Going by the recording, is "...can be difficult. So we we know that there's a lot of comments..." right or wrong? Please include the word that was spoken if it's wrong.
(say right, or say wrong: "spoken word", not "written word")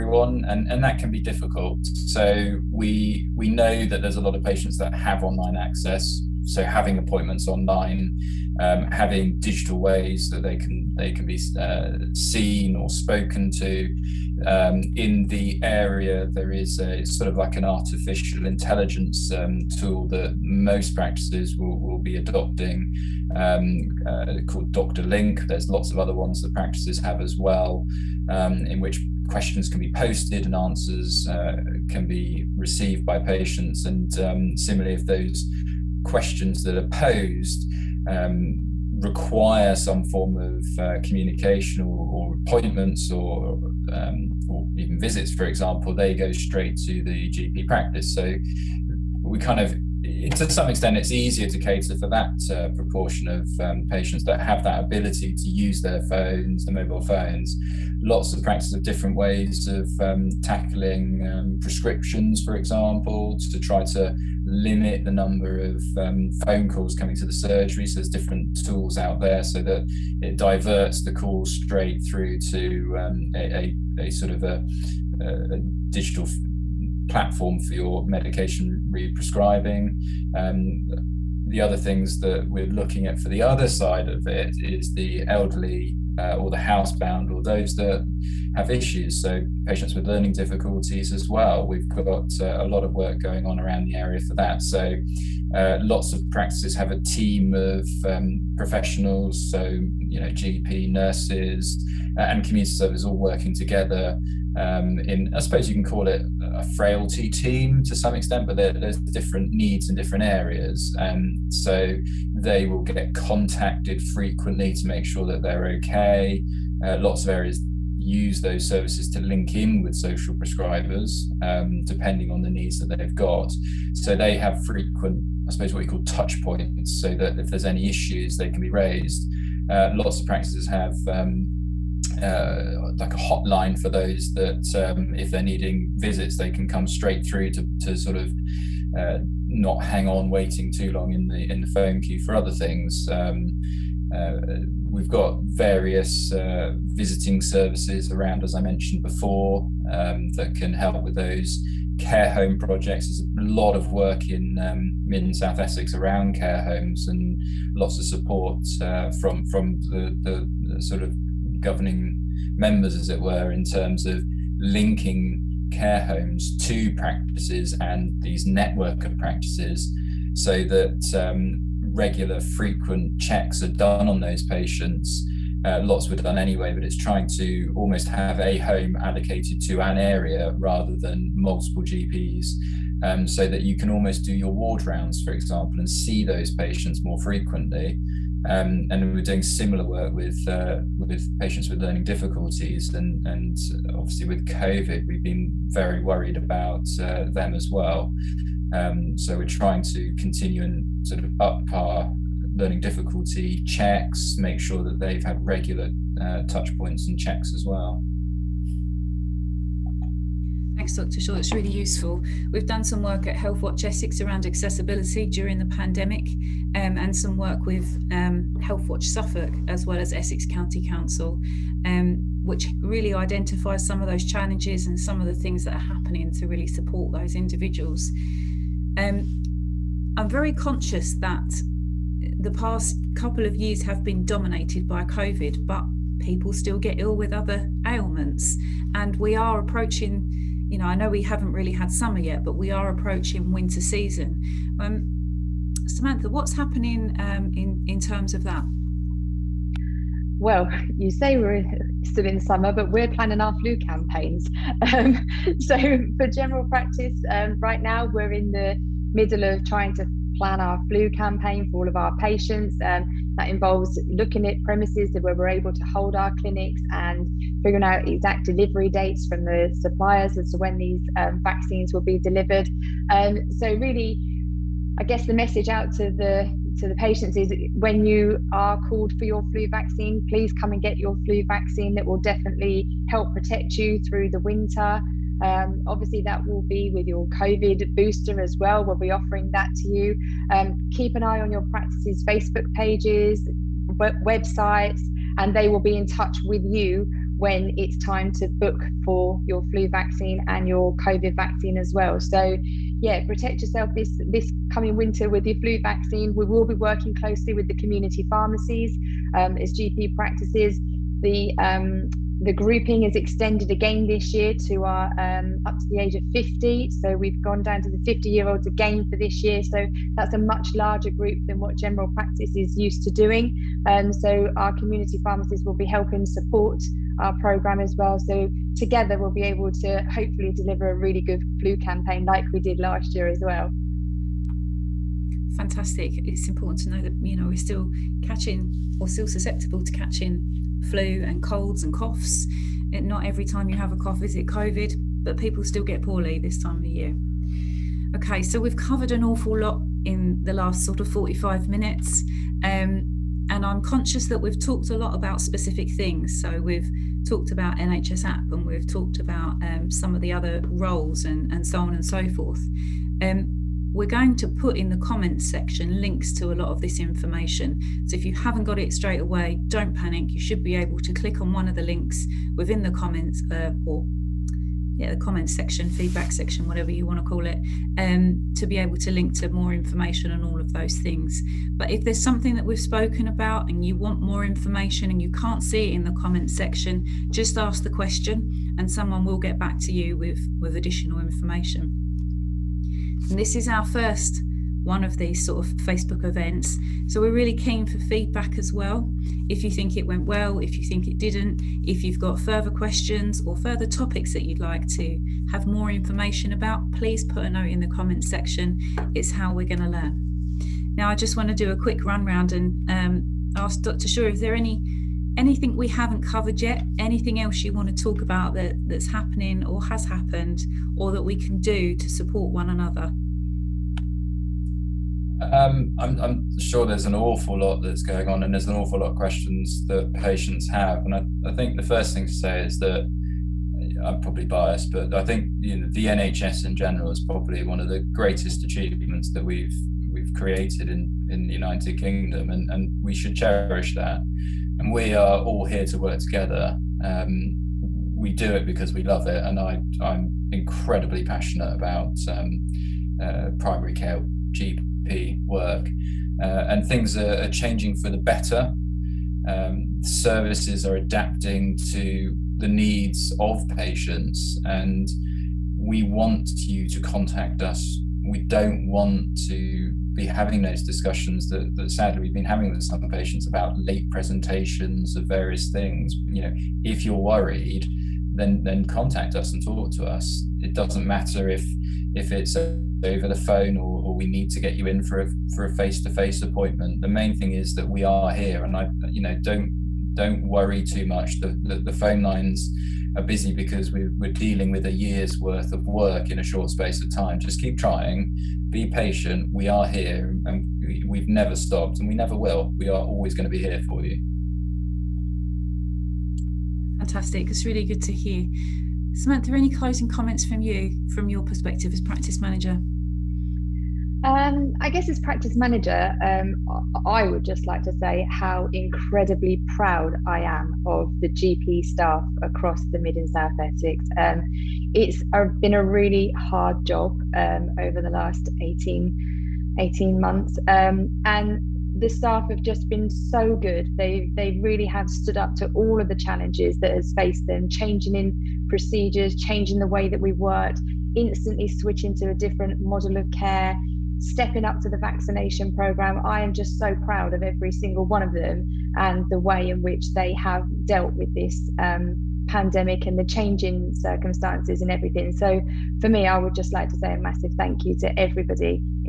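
wrong: "patients", not "comments".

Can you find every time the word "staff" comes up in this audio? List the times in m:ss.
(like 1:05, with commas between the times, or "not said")
8:41, 8:52.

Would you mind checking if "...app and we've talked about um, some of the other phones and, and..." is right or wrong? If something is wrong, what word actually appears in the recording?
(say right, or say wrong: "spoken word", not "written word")
wrong: "roles", not "phones".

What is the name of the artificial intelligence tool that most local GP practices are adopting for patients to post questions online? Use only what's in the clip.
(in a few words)
Doctorlink.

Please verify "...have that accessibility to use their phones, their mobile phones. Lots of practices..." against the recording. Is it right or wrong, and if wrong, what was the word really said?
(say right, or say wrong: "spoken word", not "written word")
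wrong: "ability", not "accessibility".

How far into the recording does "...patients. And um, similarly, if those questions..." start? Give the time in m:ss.
0:33.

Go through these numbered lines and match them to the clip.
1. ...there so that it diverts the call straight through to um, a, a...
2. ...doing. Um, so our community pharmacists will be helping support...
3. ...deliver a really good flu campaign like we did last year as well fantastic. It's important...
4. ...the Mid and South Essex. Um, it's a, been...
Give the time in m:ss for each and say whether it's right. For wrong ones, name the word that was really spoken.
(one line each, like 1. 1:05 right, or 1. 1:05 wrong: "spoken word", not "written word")
1. 1:09 right
2. 5:23 right
3. 5:30 right
4. 8:42 right.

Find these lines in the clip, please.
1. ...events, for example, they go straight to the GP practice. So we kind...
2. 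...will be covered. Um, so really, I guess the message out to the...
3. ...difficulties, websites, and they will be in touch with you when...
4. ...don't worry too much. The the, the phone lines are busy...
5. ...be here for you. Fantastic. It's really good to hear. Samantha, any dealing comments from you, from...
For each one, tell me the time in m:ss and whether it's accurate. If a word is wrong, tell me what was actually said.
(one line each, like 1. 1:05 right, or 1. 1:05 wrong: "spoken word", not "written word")
1. 0:44 wrong: "visits", not "events"
2. 4:31 wrong: "delivered", not "covered"
3. 4:52 wrong: "pages", not "difficulties"
4. 8:10 right
5. 8:23 wrong: "closing", not "dealing".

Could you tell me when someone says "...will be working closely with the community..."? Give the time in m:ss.
5:06.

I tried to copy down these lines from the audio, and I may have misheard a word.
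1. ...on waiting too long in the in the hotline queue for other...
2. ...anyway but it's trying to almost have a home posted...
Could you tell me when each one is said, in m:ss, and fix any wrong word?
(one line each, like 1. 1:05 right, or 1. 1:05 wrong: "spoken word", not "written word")
1. 2:20 wrong: "phone", not "hotline"
2. 2:56 wrong: "allocated", not "posted".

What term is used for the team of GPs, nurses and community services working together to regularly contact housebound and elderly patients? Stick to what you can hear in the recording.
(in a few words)
frailty team.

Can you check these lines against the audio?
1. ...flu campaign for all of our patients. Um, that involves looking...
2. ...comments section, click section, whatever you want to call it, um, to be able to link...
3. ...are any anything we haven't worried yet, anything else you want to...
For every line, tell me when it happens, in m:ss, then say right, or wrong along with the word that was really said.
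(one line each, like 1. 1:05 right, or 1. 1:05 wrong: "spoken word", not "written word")
1. 4:20 right
2. 6:15 wrong: "feedback", not "click"
3. 6:54 wrong: "covered", not "worried".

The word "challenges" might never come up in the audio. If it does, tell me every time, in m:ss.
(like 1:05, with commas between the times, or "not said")
3:44, 8:56.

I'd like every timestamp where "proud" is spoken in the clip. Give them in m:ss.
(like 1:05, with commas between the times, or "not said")
8:39, 9:06.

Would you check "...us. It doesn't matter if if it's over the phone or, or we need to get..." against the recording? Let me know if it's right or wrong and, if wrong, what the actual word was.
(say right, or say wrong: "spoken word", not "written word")
right.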